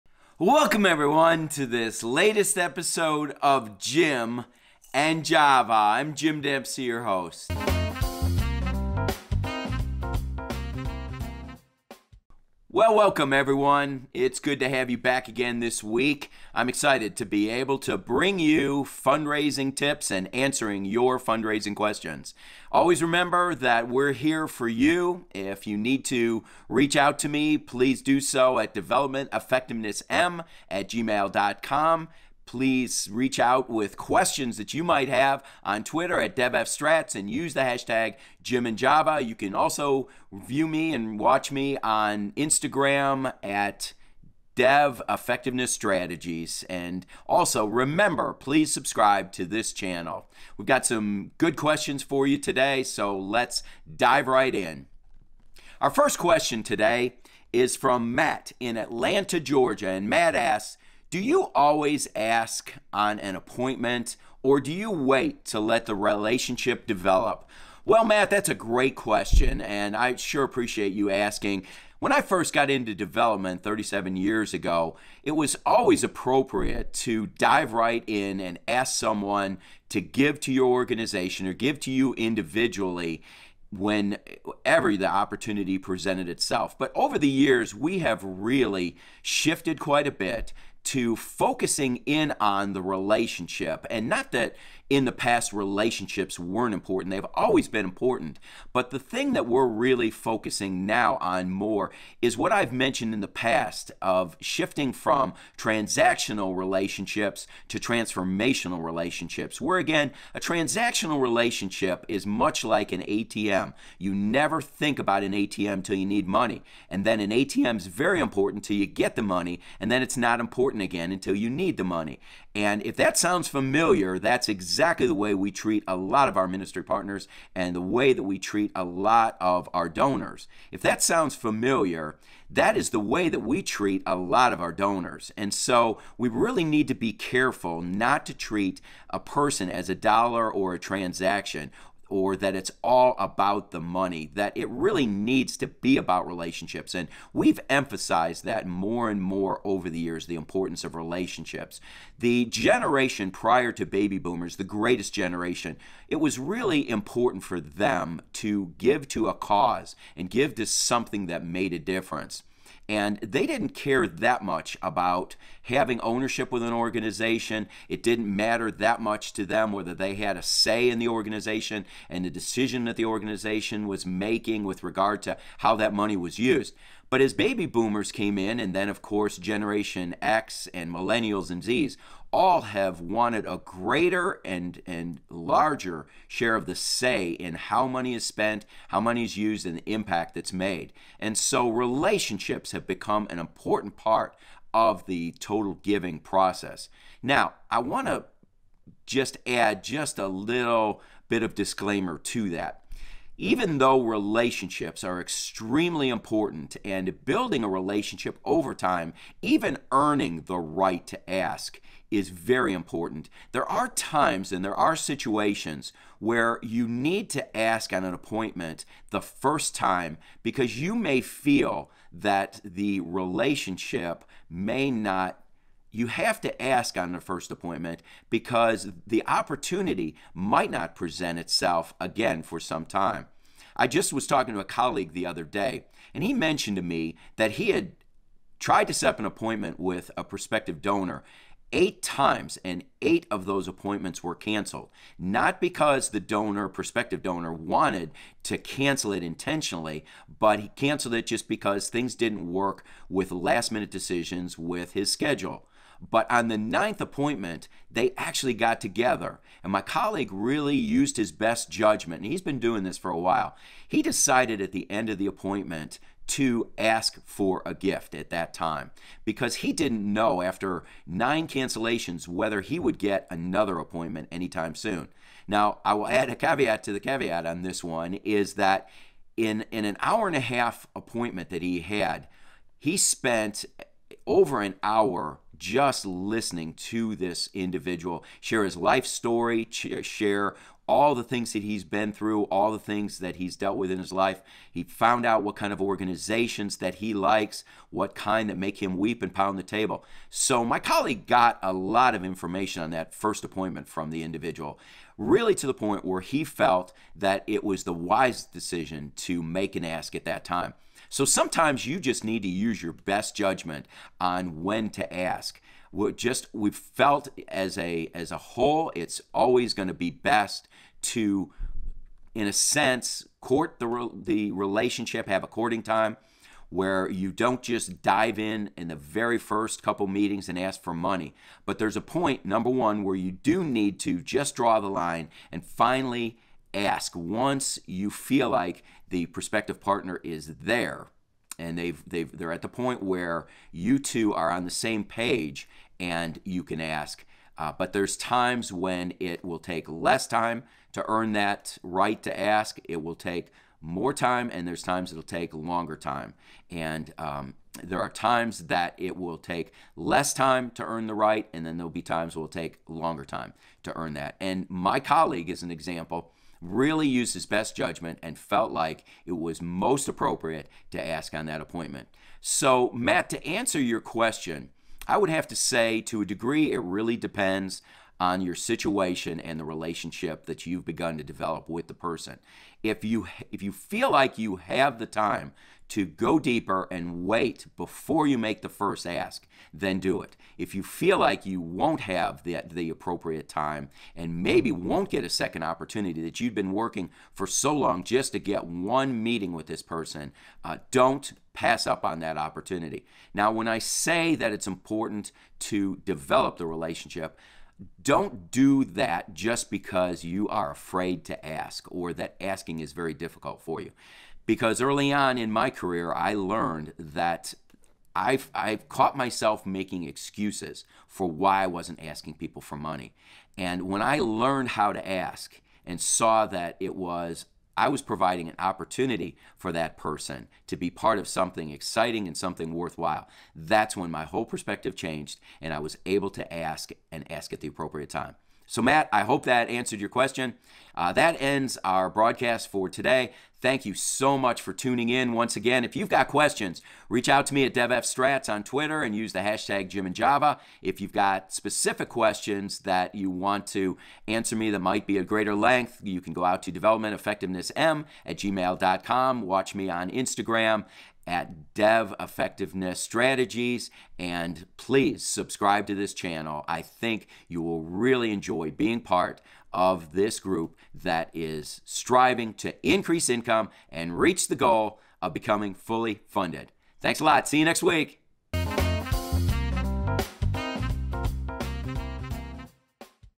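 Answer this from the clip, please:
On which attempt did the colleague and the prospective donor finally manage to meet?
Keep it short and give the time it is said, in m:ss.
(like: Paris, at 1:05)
ninth, at 4:16.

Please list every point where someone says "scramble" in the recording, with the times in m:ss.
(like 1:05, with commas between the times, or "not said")
not said.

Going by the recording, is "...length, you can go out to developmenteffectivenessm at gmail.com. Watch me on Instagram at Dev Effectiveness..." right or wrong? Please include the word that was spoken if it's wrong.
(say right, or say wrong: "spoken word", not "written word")
right.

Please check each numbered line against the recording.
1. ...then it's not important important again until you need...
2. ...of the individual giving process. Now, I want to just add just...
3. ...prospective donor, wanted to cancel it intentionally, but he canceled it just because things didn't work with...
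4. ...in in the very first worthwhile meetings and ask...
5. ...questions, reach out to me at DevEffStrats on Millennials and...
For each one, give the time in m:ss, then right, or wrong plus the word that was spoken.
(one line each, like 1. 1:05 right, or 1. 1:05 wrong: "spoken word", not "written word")
1. 1:59 right
2. 3:14 wrong: "total", not "individual"
3. 4:06 right
4. 5:28 wrong: "couple", not "worthwhile"
5. 7:26 wrong: "Twitter", not "Millennials".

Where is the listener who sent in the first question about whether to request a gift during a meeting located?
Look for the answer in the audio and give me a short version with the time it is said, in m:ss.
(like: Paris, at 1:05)
Atlanta, Georgia, at 0:58.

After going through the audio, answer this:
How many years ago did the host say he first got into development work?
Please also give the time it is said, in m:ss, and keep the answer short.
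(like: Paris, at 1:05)
37, at 1:13.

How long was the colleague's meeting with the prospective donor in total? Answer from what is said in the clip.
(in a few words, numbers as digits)
an hour and a half.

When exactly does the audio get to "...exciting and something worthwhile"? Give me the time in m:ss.
7:11.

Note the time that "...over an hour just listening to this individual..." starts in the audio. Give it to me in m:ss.
4:44.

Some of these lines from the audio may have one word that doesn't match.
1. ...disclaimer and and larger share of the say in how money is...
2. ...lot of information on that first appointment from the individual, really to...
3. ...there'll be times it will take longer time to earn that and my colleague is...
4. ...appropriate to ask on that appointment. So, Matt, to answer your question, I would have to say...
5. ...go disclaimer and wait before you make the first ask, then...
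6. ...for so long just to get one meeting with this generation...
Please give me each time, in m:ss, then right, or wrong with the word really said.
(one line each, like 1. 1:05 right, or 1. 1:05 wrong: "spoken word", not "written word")
1. 3:03 wrong: "greater", not "disclaimer"
2. 5:01 right
3. 6:01 right
4. 6:10 right
5. 6:26 wrong: "deeper", not "disclaimer"
6. 6:37 wrong: "person", not "generation".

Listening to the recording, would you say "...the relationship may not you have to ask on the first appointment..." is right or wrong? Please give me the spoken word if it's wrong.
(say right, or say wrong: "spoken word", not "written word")
right.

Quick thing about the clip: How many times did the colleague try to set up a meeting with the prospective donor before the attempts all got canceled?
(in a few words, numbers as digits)
8.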